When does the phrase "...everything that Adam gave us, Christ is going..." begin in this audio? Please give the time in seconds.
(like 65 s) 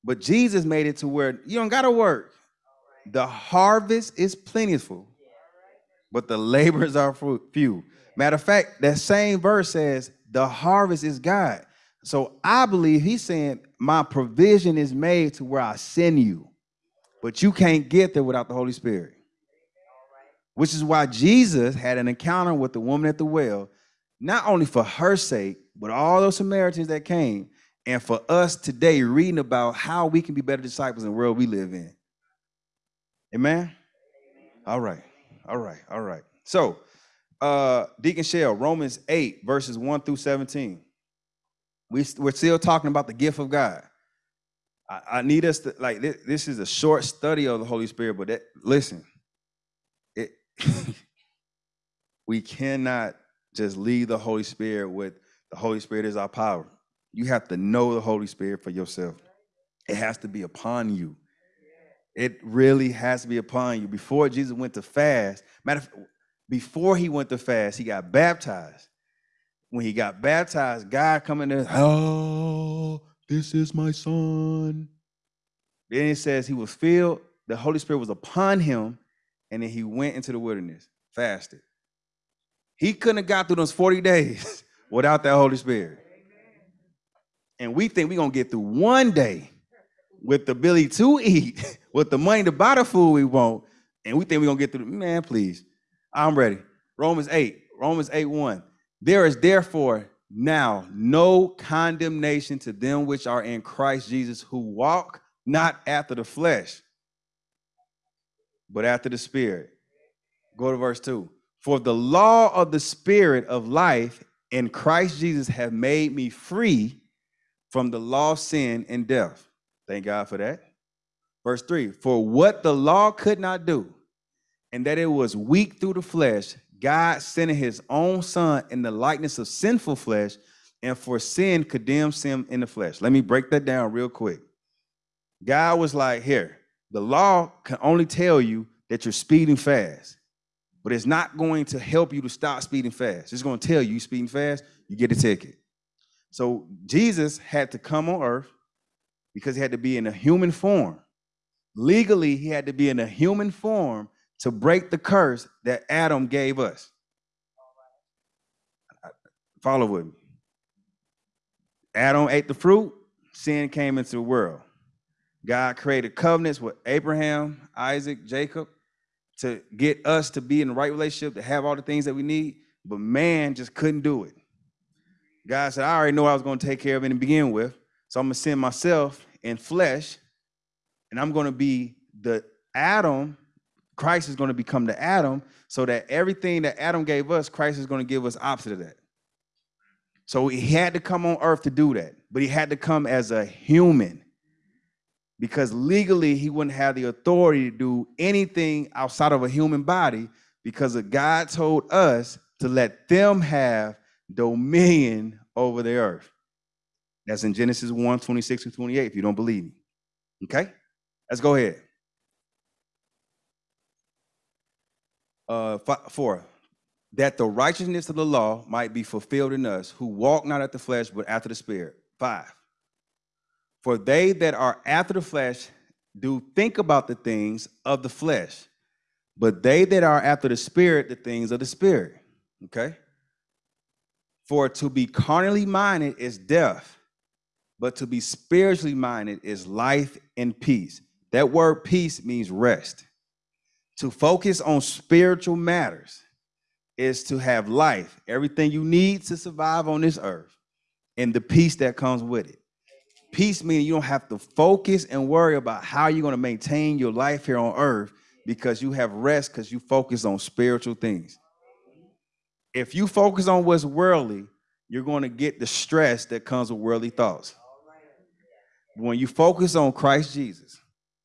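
186 s.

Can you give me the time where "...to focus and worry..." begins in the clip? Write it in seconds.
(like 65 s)
254 s.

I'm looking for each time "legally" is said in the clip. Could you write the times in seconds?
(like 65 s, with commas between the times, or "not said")
151 s, 195 s.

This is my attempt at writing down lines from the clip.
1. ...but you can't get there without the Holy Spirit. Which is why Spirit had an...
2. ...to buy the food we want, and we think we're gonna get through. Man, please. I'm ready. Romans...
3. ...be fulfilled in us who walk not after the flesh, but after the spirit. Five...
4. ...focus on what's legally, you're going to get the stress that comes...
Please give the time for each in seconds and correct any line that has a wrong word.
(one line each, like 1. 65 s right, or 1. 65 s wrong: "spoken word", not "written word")
1. 17 s wrong: "Jesus", not "Spirit"
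2. 92 s right
3. 218 s right
4. 263 s wrong: "worldly", not "legally".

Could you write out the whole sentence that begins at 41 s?
We, we're still talking about the gift of God.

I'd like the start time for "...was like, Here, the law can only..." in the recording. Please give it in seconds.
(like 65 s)
135 s.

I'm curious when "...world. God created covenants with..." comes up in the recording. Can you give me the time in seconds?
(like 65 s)
164 s.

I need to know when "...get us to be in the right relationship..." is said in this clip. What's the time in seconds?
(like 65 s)
169 s.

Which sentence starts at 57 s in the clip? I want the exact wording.
You have to know the Holy Spirit for yourself.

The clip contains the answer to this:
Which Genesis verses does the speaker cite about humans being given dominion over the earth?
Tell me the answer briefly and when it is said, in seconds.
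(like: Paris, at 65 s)
Genesis 1:26 and 28, at 207 s.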